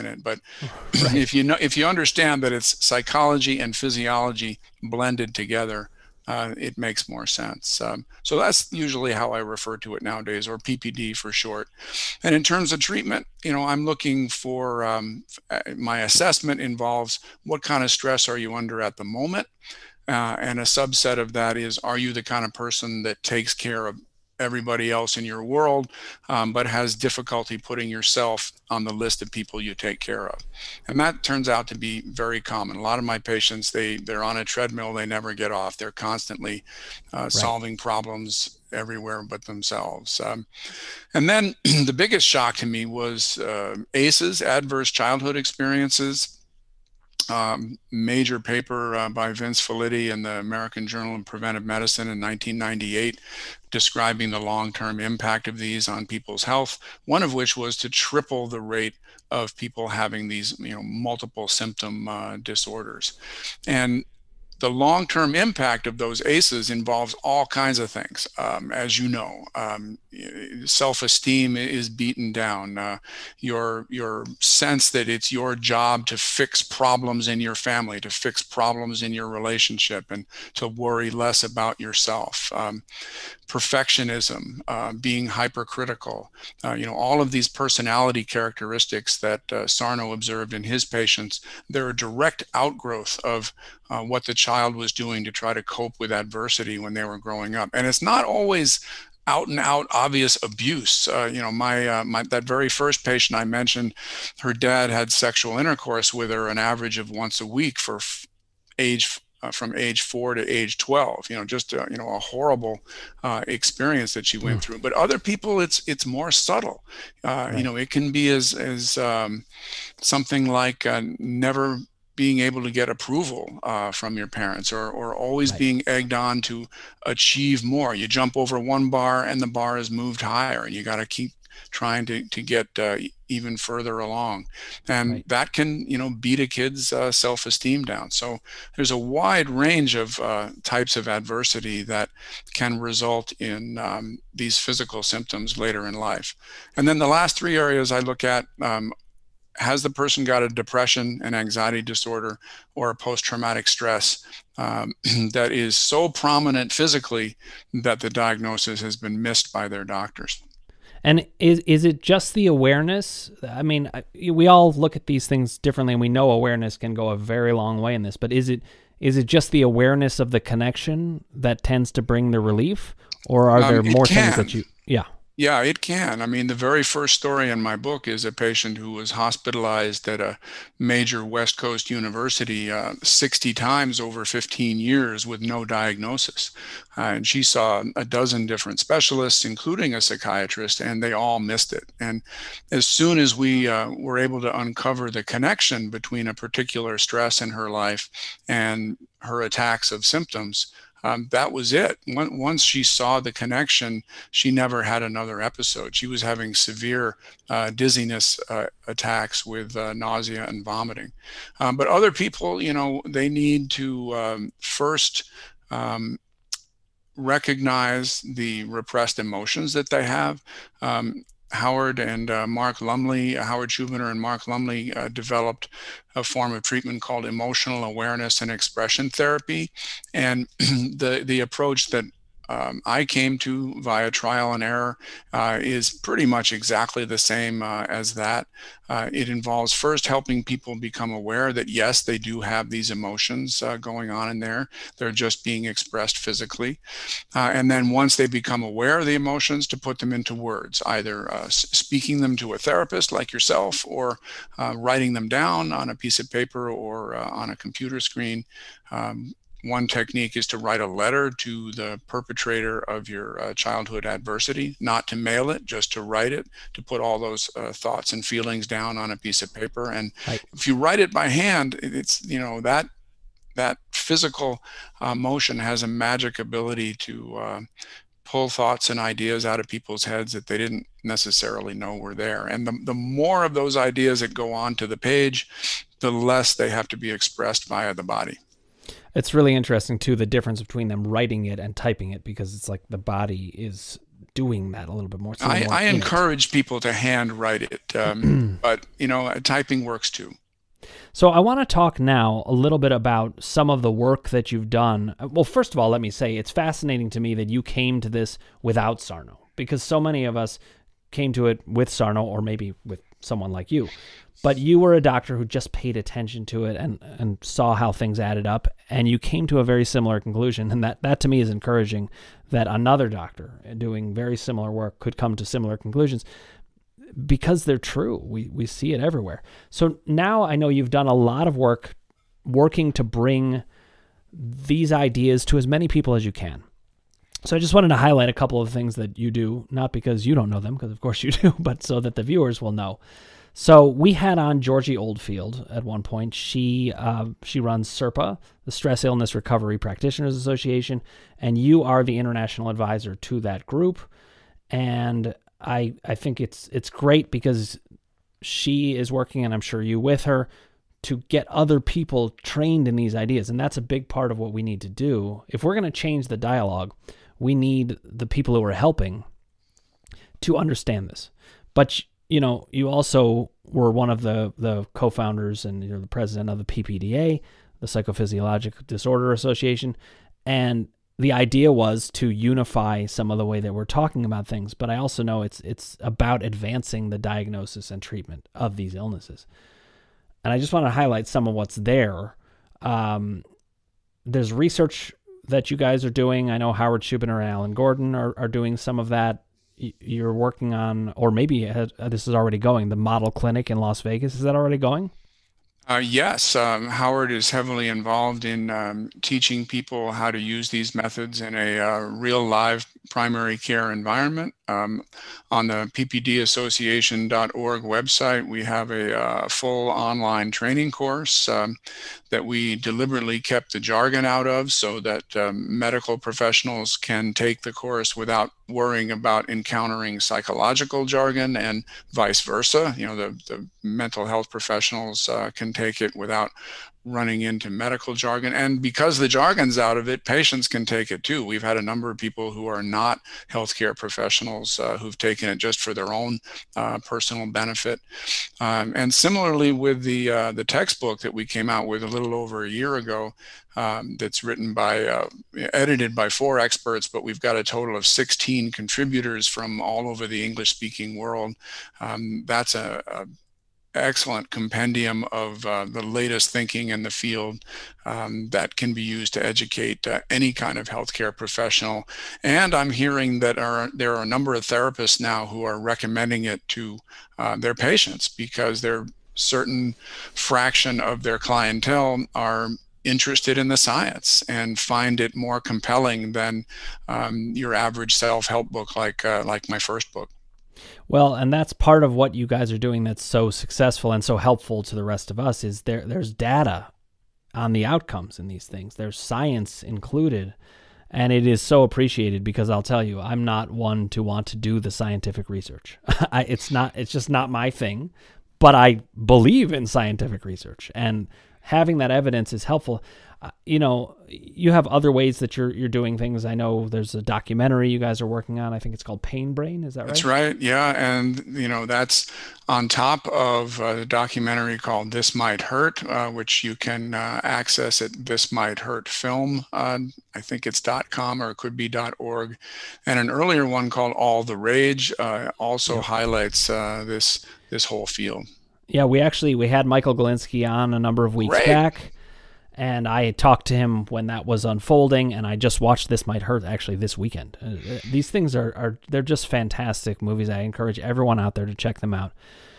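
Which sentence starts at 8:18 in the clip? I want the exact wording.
There's science included and it is so appreciated because I'll tell you, I'm not one to want to do the scientific research.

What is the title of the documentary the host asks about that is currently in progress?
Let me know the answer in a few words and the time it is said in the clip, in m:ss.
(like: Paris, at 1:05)
Pain Brain, at 8:39.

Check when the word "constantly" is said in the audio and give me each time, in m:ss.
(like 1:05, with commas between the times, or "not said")
0:35.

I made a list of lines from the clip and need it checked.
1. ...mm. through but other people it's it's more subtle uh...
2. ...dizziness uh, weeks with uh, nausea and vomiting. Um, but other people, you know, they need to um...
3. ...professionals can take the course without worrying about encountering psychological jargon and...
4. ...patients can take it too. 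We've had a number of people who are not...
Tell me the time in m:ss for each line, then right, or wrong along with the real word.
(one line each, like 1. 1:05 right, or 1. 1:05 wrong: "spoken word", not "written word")
1. 1:54 right
2. 3:27 wrong: "attacks", not "weeks"
3. 7:06 right
4. 7:20 right.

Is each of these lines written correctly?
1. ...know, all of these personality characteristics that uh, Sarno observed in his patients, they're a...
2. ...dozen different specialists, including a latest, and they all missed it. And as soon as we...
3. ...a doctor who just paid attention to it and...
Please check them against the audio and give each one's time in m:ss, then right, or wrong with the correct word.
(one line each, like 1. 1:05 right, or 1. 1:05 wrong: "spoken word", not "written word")
1. 1:26 right
2. 3:08 wrong: "psychiatrist", not "latest"
3. 5:14 right.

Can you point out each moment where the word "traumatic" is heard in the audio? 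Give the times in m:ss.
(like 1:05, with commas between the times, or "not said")
2:33.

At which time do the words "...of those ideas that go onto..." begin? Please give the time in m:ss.
4:43.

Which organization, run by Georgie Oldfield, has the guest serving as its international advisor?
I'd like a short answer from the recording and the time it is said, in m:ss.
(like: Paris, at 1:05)
Stress Illness Recovery Practitioners Association, at 5:48.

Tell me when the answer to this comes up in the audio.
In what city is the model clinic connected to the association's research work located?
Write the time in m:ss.
6:43.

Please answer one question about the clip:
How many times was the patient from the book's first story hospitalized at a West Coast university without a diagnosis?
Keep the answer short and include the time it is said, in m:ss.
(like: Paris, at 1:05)
60, at 3:03.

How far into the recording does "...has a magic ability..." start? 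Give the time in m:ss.
4:35.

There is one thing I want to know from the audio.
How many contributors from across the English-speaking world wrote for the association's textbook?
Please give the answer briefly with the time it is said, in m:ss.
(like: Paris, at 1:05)
16, at 7:38.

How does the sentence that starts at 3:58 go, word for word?
Uh, it involves first helping people become aware that yes, they do have these emotions uh, going on in there.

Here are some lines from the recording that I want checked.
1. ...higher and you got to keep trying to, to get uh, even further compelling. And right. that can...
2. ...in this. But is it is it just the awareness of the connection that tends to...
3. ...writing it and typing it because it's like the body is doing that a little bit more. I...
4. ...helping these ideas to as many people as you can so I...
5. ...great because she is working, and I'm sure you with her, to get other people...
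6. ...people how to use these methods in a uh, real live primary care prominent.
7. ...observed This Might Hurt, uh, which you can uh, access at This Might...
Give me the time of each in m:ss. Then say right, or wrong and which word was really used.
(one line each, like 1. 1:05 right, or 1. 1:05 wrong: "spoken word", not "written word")
1. 2:10 wrong: "along", not "compelling"
2. 2:47 right
3. 4:51 right
4. 5:33 wrong: "bring", not "helping"
5. 5:56 right
6. 6:49 wrong: "environment", not "prominent"
7. 8:44 wrong: "called", not "observed".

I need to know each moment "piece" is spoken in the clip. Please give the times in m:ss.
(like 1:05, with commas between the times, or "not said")
4:15, 4:29.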